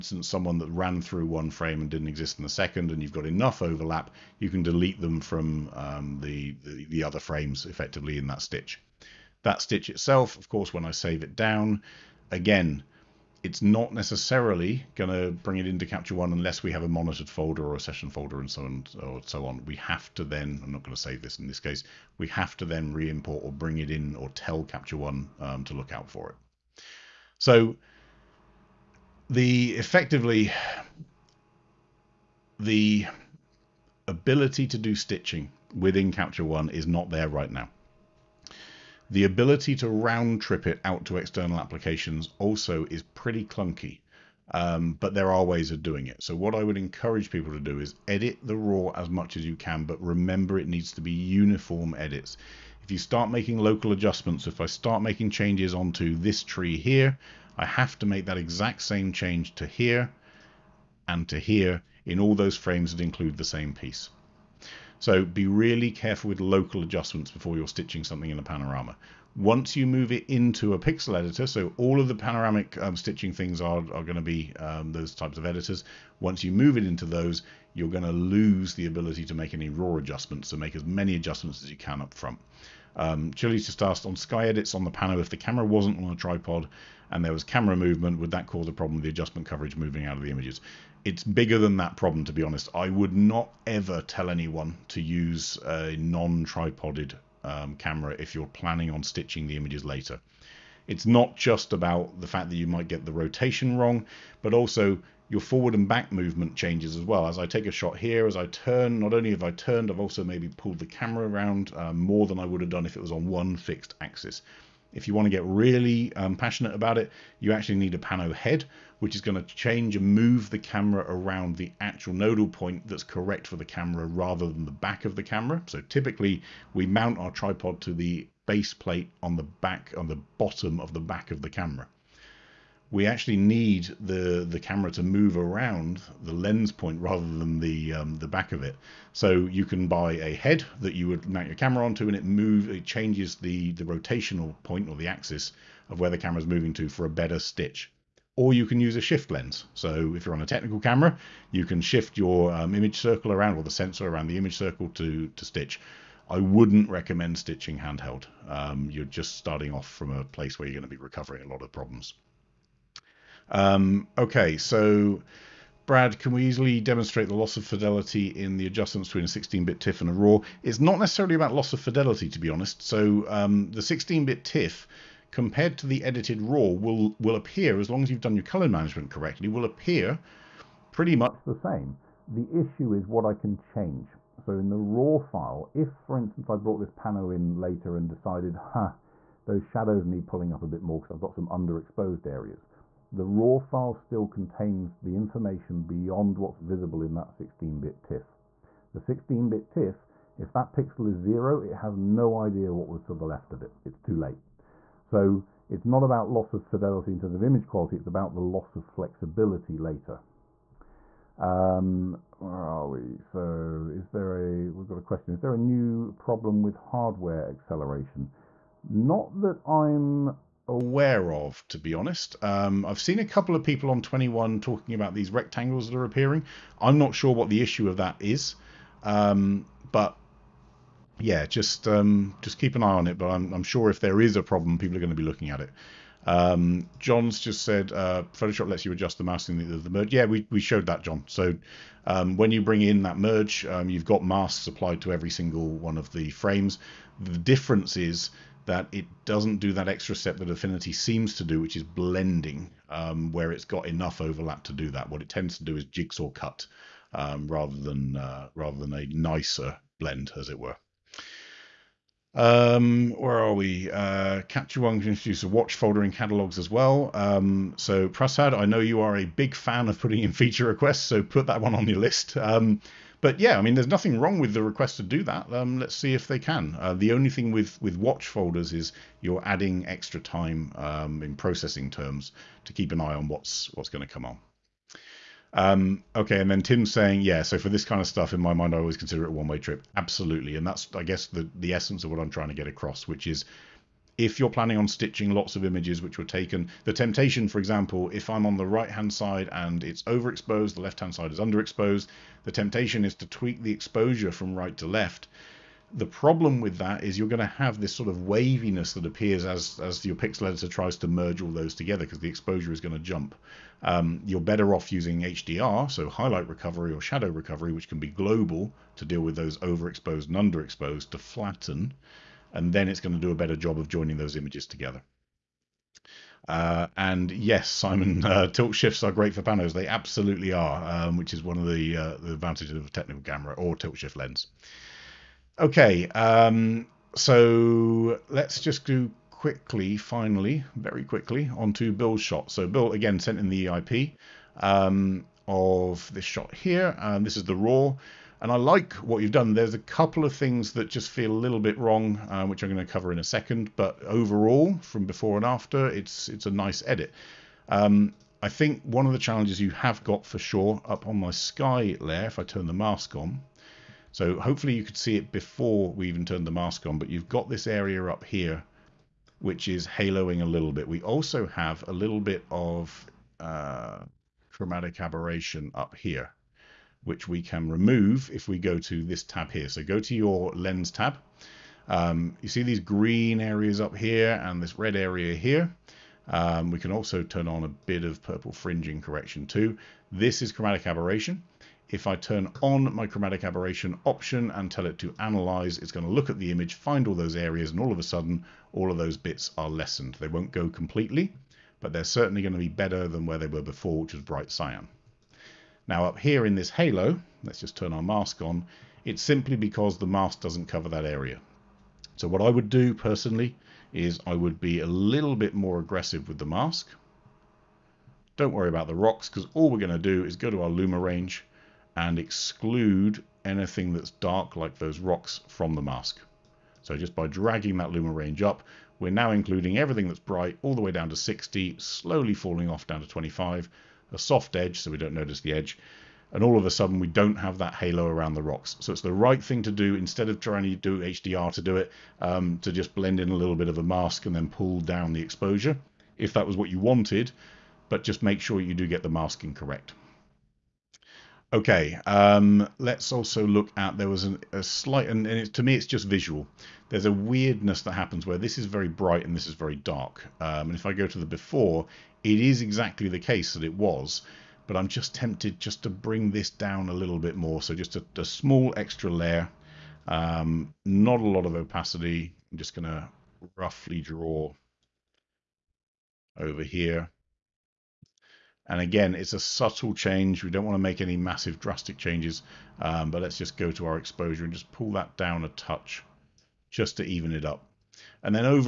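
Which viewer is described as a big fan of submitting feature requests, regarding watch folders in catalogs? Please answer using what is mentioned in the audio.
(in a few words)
Prasad.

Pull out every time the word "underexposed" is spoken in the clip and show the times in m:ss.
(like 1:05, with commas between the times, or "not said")
3:11, 5:01, 5:20.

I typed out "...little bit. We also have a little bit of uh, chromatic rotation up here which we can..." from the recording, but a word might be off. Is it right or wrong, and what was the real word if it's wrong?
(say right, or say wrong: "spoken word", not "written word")
wrong: "aberration", not "rotation".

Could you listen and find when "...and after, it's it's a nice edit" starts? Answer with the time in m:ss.
5:55.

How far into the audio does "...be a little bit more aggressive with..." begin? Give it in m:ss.
6:54.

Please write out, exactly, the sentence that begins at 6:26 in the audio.
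Um, we can also turn on a bit of purple fringing correction too.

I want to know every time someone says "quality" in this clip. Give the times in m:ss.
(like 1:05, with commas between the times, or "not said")
3:27.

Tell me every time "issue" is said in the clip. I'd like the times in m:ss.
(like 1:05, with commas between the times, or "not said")
3:02, 3:47.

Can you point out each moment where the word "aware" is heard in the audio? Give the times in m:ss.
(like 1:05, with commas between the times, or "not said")
3:40.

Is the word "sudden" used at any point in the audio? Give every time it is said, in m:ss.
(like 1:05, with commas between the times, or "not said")
6:38, 7:16.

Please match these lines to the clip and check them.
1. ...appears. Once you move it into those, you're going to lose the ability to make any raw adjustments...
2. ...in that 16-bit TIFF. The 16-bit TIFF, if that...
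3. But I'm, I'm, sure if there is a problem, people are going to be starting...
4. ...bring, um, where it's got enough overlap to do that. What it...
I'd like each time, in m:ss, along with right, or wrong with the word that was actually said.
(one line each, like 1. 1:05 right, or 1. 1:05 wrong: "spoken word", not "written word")
1. 1:15 wrong: "editors", not "appears"
2. 3:17 right
3. 3:53 wrong: "looking", not "starting"
4. 4:11 wrong: "blending", not "bring".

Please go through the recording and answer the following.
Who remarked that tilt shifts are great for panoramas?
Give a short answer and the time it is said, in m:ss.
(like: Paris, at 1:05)
Simon, at 5:27.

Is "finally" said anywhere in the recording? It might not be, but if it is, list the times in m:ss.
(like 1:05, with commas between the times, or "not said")
5:39.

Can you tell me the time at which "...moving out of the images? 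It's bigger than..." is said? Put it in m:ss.
1:29.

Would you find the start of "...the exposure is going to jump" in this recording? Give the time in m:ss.
5:12.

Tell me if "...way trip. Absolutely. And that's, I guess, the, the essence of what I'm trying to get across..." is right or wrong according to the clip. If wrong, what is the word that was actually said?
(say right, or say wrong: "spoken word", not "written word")
right.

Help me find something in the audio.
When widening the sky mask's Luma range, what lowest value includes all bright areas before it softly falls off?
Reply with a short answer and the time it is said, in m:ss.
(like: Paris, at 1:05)
60, at 7:11.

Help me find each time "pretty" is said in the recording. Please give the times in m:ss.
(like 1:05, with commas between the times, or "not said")
0:43, 3:00.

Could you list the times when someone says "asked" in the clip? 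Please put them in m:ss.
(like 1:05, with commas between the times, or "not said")
1:23.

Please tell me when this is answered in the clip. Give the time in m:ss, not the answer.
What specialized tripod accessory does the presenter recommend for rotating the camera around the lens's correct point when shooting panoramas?
1:57.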